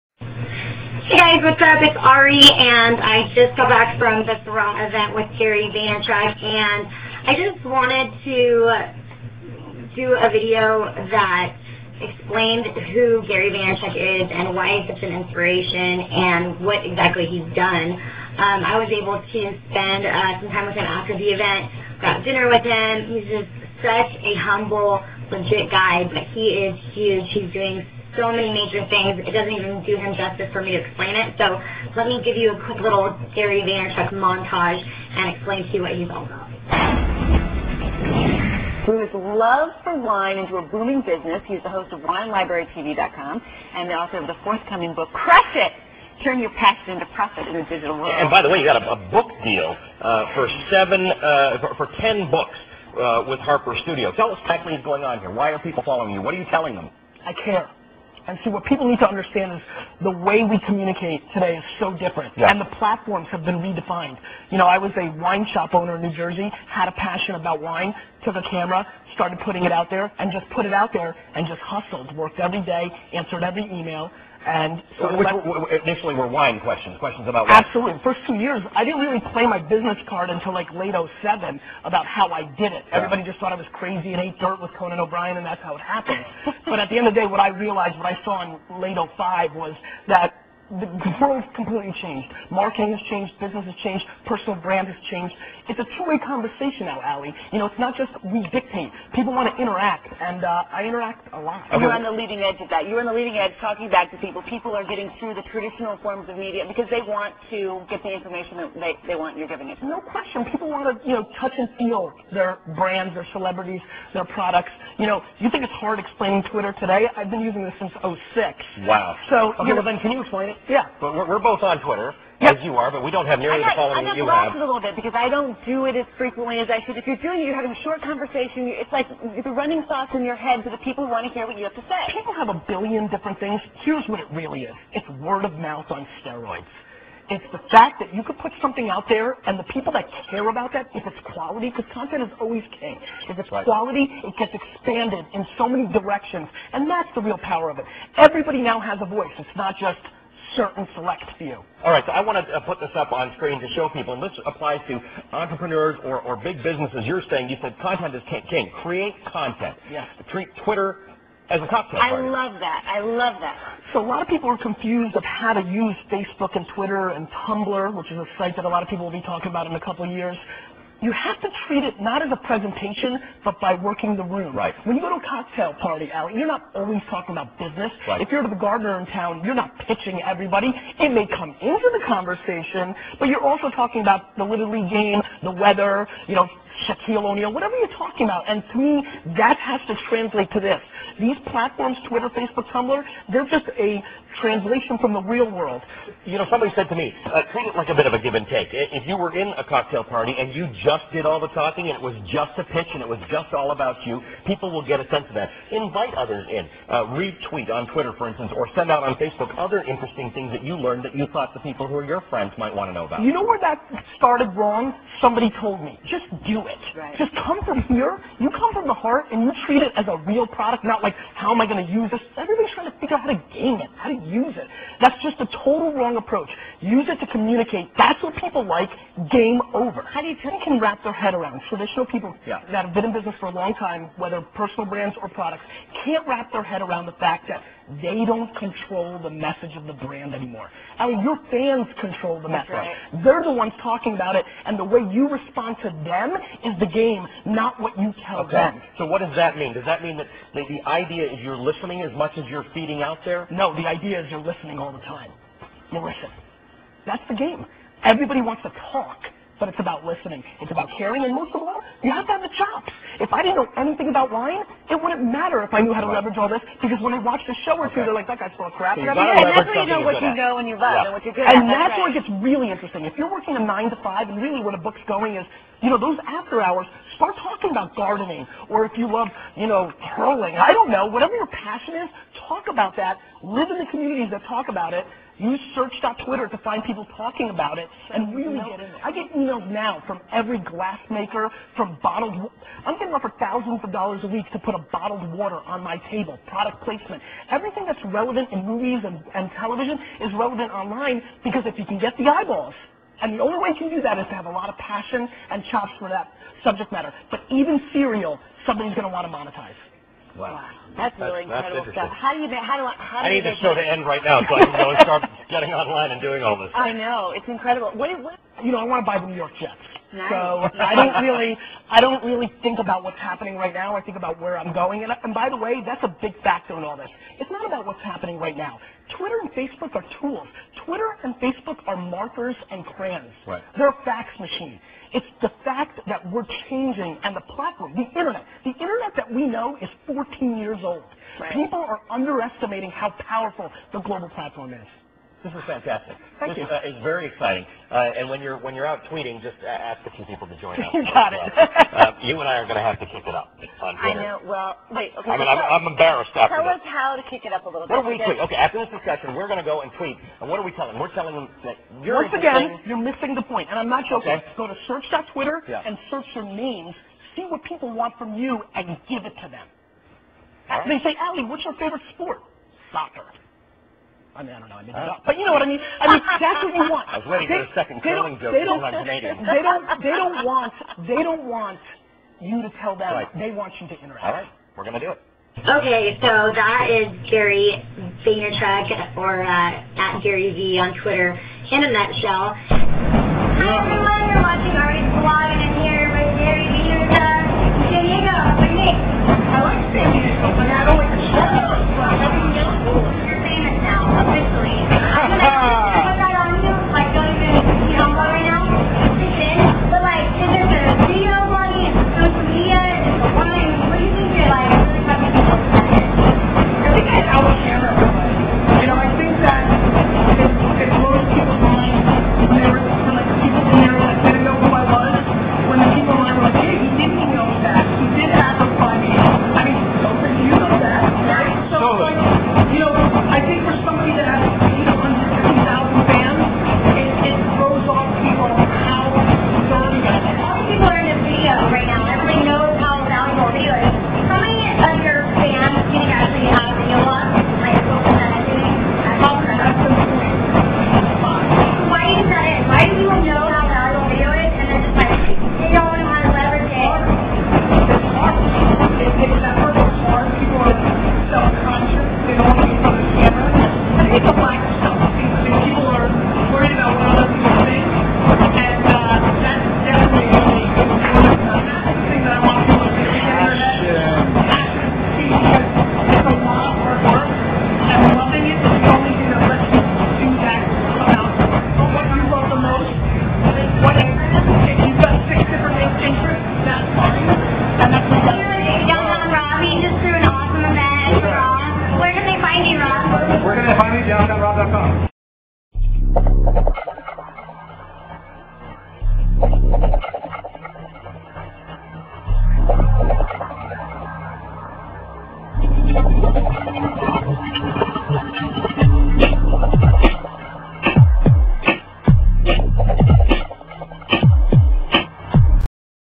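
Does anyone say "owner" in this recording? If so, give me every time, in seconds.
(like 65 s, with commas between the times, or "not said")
65 s.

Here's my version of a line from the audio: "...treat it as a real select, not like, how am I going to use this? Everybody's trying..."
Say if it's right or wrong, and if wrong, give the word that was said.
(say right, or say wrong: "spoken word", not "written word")
wrong: "product", not "select".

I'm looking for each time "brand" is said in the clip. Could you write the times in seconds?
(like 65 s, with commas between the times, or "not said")
94 s, 112 s, 234 s, 239 s.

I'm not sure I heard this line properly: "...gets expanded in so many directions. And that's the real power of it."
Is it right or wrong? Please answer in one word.
right.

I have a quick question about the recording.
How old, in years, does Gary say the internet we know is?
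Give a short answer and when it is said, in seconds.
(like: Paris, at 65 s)
14, at 340 s.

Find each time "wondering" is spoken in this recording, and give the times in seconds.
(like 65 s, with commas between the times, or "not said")
not said.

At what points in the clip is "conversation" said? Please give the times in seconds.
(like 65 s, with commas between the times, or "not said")
96 s, 128 s, 182 s.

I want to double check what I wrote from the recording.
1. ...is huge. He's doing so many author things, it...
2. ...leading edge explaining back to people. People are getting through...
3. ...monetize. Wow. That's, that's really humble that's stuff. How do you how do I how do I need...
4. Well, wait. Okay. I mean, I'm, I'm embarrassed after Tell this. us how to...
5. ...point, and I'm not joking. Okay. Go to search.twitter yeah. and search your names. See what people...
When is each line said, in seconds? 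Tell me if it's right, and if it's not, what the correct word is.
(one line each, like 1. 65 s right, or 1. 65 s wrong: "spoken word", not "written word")
1. 26 s wrong: "major", not "author"
2. 103 s wrong: "talking", not "explaining"
3. 309 s wrong: "incredible", not "humble"
4. 354 s right
5. 363 s right.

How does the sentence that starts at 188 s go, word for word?
And to me, that has to translate to this.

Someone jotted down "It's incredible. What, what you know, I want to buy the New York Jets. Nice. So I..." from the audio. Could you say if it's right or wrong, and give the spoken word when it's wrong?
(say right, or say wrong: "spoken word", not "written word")
right.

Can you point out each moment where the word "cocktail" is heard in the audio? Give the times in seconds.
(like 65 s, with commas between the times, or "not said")
161 s, 175 s, 199 s.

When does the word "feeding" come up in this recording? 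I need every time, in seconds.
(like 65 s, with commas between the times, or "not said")
252 s.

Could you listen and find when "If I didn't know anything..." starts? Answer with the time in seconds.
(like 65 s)
263 s.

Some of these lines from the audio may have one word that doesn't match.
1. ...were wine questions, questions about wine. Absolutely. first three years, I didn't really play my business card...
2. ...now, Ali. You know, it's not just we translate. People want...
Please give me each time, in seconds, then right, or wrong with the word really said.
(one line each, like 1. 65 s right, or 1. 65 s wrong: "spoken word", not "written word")
1. 76 s wrong: "two", not "three"
2. 96 s wrong: "dictate", not "translate".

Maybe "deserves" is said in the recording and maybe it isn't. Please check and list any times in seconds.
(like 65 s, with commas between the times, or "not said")
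not said.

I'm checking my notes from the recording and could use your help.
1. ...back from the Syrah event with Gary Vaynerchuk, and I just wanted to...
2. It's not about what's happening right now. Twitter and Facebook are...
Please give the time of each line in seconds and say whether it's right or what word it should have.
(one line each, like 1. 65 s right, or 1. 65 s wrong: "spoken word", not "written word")
1. 3 s right
2. 327 s right.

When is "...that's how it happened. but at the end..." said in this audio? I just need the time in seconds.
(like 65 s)
85 s.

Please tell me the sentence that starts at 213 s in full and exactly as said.
You know where that started wrong?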